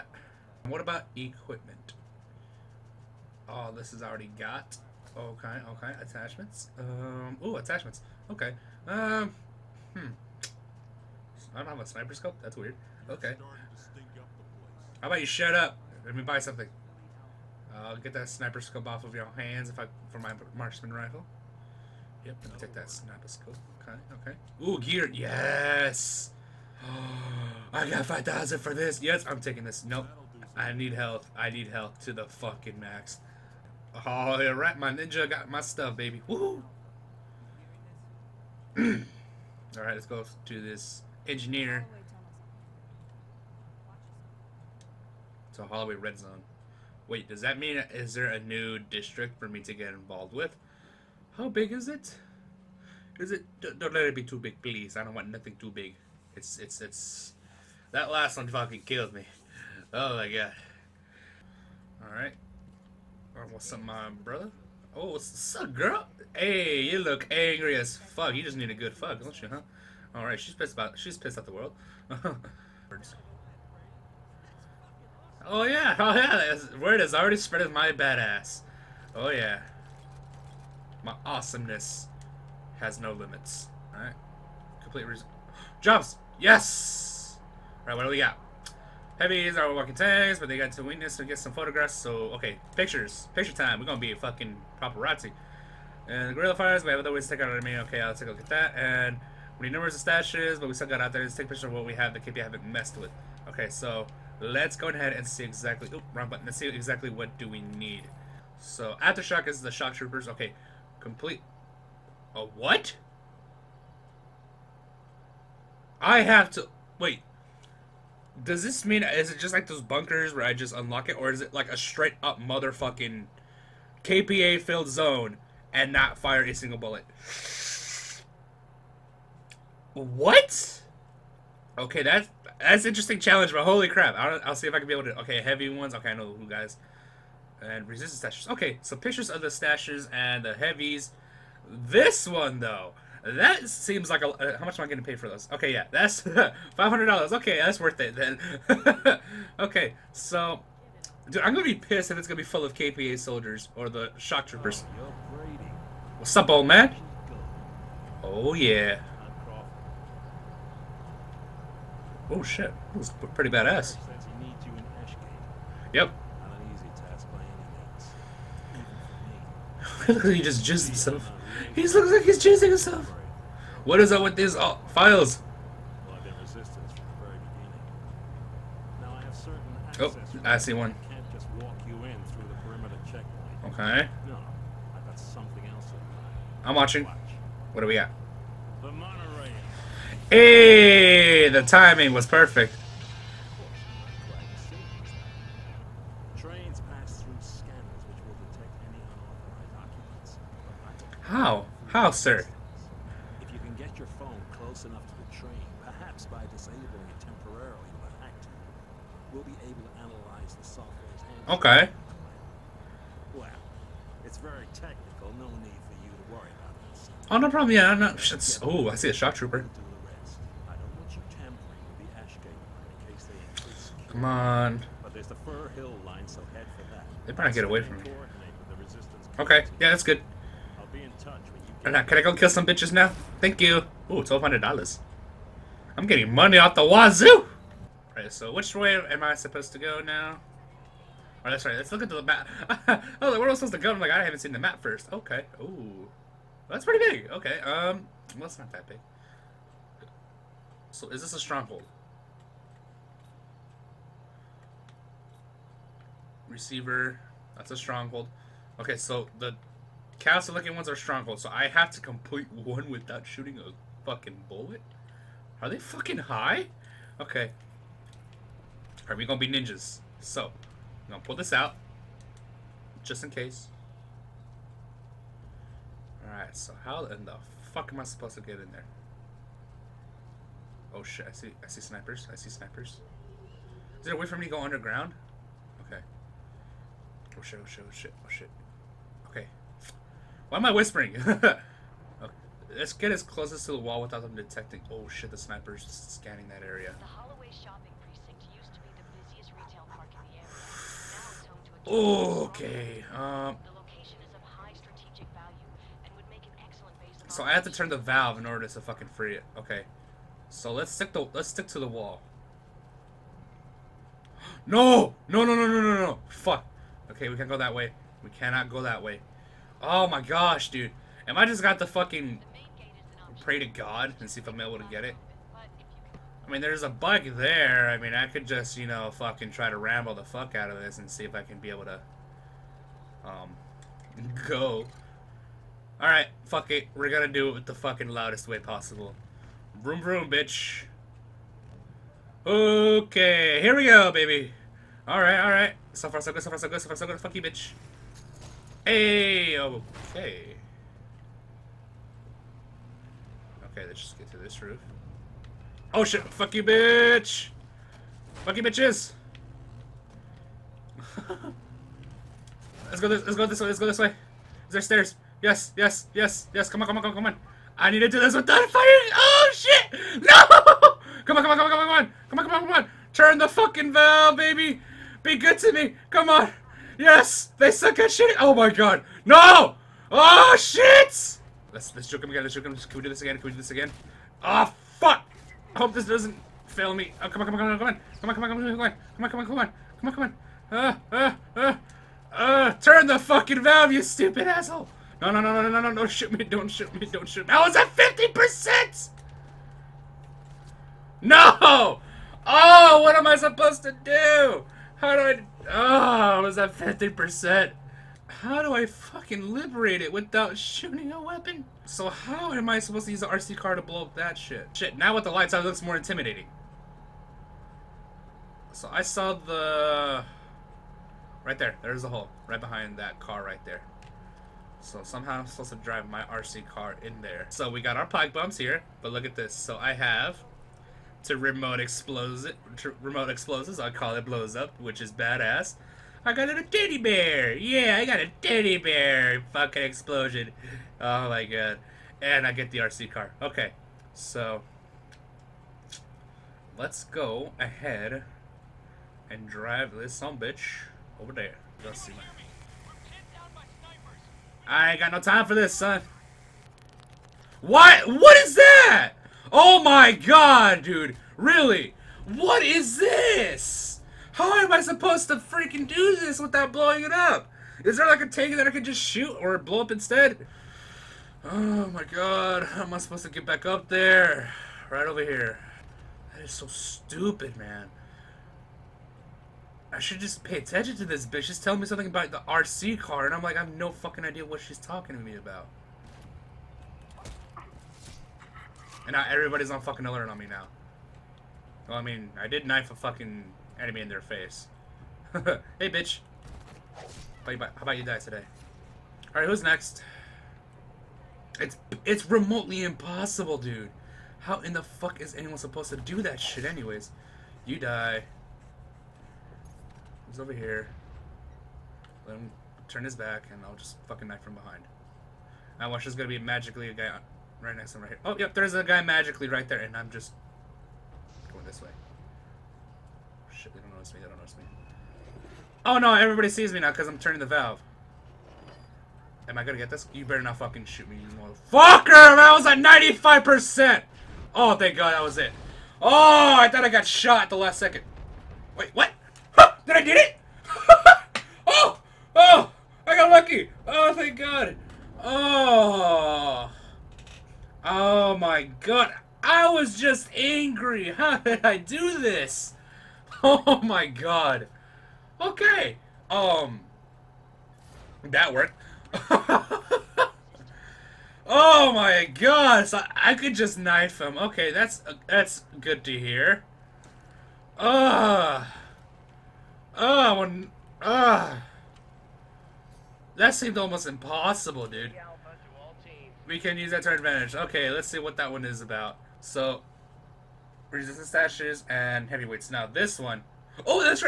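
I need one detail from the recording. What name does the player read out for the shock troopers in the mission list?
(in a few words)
Aftershock.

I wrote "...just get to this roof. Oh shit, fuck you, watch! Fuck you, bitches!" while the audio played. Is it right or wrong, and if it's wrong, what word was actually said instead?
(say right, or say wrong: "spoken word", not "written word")
wrong: "bitch", not "watch".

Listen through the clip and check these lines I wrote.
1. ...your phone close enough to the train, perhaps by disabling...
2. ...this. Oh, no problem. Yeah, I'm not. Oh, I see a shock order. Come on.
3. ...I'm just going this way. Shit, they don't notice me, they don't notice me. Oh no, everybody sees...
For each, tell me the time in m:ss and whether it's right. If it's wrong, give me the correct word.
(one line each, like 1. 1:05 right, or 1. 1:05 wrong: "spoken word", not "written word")
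1. 3:23 right
2. 3:36 wrong: "trooper", not "order"
3. 8:39 right.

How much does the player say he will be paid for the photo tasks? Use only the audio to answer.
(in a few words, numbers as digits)
$500.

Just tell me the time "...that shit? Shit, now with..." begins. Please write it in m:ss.
6:54.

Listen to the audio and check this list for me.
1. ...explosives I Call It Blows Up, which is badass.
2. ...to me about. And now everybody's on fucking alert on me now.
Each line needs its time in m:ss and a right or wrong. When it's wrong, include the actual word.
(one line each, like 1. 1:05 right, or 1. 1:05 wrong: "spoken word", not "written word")
1. 7:13 right
2. 8:05 right.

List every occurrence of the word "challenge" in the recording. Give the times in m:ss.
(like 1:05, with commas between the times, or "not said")
2:13.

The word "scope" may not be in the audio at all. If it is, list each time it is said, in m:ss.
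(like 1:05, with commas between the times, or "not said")
0:12, 0:18, 0:23.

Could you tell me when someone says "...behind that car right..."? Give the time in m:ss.
7:02.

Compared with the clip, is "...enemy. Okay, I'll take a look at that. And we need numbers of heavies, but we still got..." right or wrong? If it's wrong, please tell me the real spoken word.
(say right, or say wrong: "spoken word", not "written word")
wrong: "stashes", not "heavies".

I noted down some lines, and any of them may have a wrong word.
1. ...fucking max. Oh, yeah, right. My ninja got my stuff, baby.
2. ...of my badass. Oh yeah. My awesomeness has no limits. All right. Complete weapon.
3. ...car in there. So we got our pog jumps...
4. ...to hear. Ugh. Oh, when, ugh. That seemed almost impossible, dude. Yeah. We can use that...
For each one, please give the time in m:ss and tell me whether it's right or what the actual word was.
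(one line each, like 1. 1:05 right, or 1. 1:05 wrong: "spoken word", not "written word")
1. 0:32 right
2. 1:17 wrong: "reason", not "weapon"
3. 7:06 wrong: "bumps", not "jumps"
4. 9:26 right.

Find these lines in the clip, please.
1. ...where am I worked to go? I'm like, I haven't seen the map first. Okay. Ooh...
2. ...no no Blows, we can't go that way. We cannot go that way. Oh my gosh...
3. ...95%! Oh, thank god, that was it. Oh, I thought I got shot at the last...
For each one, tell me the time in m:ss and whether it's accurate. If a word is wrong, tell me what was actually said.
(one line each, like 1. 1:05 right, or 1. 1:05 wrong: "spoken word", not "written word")
1. 4:03 wrong: "supposed", not "worked"
2. 5:15 wrong: "Okay", not "Blows"
3. 8:52 right.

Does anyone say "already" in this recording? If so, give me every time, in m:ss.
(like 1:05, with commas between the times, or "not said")
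0:04, 1:17.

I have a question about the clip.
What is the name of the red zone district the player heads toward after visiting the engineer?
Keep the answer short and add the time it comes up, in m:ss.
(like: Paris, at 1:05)
Holloway, at 0:45.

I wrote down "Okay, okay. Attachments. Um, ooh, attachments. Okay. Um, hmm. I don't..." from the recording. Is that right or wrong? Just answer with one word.
right.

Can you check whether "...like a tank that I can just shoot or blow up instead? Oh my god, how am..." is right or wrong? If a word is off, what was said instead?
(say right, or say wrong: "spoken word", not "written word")
right.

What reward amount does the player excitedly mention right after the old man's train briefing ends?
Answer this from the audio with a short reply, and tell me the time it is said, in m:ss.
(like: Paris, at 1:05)
$1200, at 3:54.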